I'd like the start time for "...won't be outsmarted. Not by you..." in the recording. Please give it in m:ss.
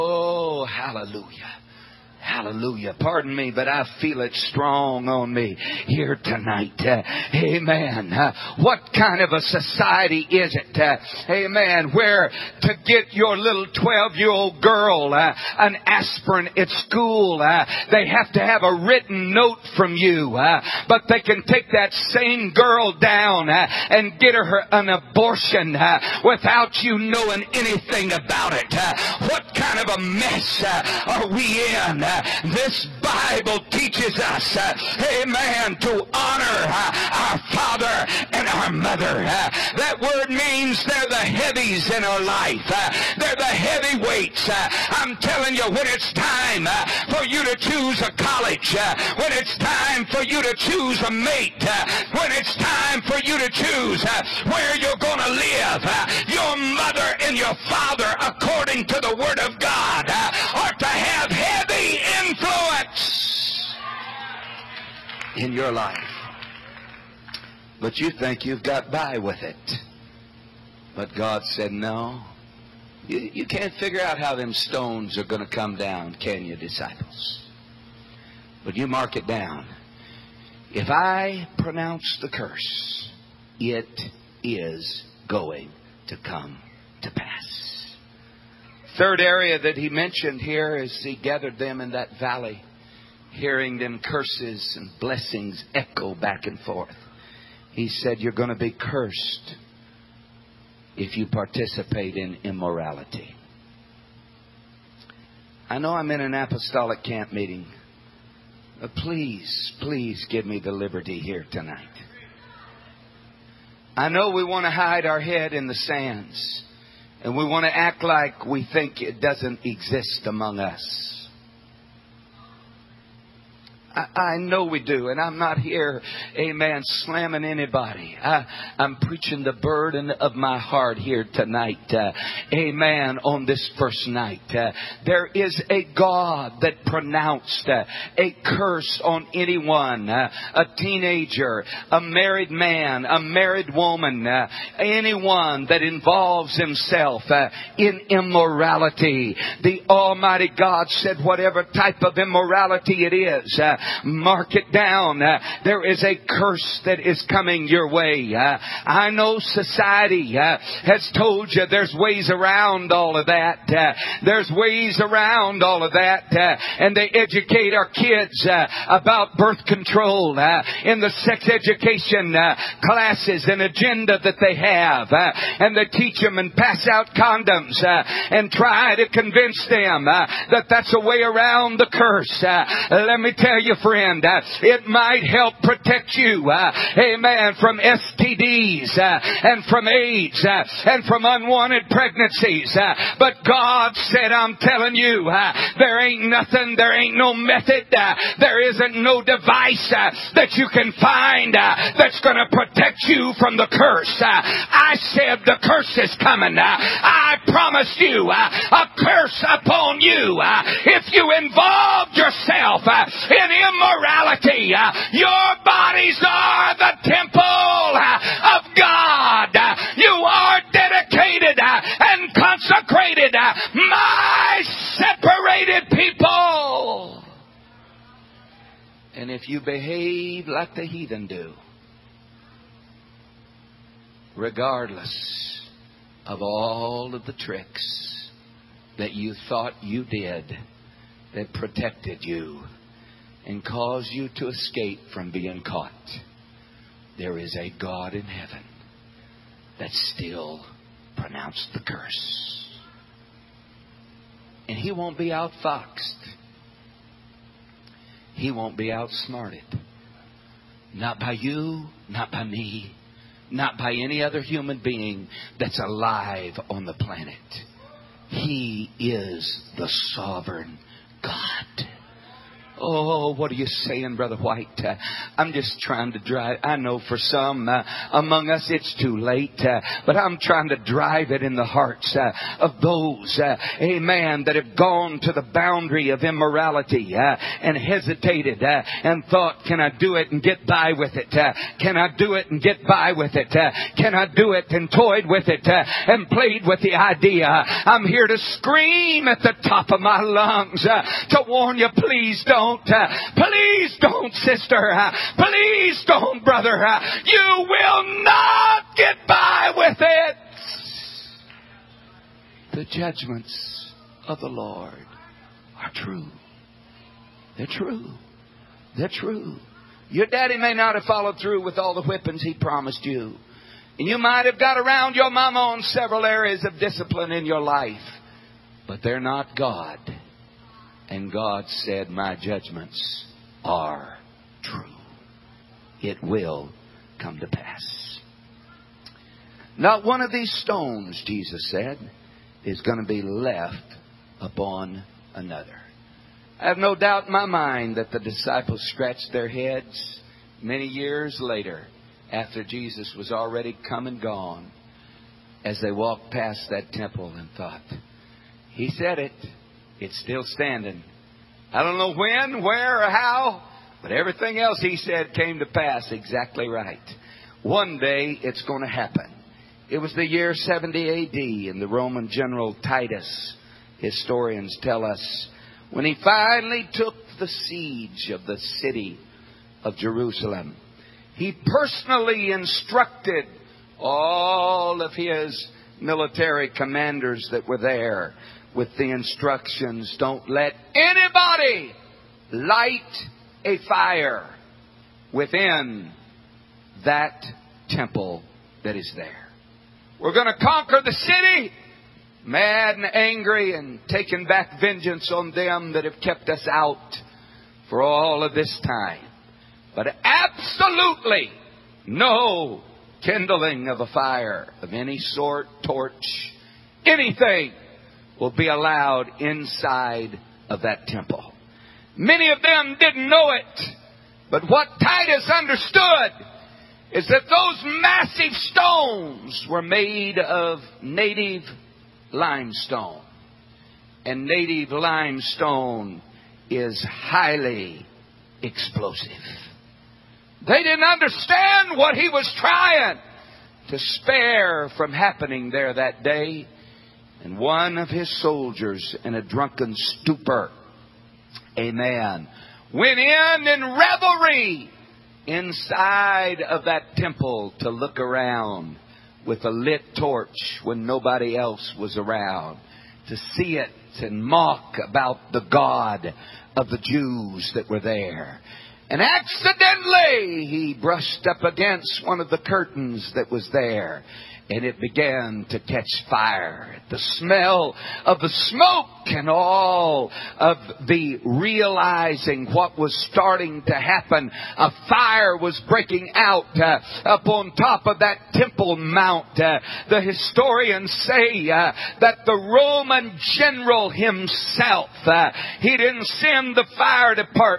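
4:18.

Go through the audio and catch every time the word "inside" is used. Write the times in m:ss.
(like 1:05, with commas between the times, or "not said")
6:59, 7:35.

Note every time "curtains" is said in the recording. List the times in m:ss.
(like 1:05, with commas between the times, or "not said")
7:52.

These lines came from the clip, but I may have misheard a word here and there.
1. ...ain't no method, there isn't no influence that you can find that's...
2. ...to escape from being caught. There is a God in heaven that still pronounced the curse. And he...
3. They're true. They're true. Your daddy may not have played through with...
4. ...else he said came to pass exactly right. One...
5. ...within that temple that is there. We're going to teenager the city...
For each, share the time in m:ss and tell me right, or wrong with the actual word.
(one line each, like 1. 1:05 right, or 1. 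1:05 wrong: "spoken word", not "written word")
1. 3:16 wrong: "device", not "influence"
2. 4:04 right
3. 5:17 wrong: "followed", not "played"
4. 6:04 right
5. 6:35 wrong: "conquer", not "teenager".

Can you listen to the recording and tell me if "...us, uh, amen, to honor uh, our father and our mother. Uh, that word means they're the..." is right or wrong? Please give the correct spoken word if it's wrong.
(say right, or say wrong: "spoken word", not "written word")
right.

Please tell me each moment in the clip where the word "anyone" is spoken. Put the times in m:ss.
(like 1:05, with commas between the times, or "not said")
2:19, 2:24.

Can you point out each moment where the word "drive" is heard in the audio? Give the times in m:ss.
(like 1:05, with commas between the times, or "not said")
4:36, 4:40.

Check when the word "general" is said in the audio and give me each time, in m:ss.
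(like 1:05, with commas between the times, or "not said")
6:12, 8:13.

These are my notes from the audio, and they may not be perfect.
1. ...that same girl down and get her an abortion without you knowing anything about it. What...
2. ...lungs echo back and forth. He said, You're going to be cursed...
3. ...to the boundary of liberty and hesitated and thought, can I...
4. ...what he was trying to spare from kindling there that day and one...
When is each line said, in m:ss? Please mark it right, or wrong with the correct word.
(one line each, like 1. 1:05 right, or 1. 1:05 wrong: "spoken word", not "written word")
1. 0:21 right
2. 1:35 wrong: "blessings", not "lungs"
3. 4:45 wrong: "immorality", not "liberty"
4. 7:21 wrong: "happening", not "kindling".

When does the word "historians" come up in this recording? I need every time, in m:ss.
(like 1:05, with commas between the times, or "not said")
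6:13, 8:10.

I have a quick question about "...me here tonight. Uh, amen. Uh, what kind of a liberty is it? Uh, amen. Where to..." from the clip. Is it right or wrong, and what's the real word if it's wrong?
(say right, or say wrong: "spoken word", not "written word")
wrong: "society", not "liberty".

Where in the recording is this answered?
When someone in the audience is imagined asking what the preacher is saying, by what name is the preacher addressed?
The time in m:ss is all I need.
4:34.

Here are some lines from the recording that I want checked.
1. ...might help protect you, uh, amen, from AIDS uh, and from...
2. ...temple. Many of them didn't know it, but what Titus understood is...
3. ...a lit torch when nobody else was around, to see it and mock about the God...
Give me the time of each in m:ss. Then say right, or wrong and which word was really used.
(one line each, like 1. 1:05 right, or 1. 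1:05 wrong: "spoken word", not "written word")
1. 3:04 wrong: "STDs", not "AIDS"
2. 7:01 right
3. 7:39 right.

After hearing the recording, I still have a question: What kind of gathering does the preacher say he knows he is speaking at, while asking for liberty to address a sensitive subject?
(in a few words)
apostolic camp meeting.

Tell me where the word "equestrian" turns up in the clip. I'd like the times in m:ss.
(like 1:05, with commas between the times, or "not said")
not said.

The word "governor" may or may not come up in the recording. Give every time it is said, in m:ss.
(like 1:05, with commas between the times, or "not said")
not said.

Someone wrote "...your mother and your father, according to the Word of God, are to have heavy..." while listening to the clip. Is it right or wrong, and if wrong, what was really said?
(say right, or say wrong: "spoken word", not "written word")
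right.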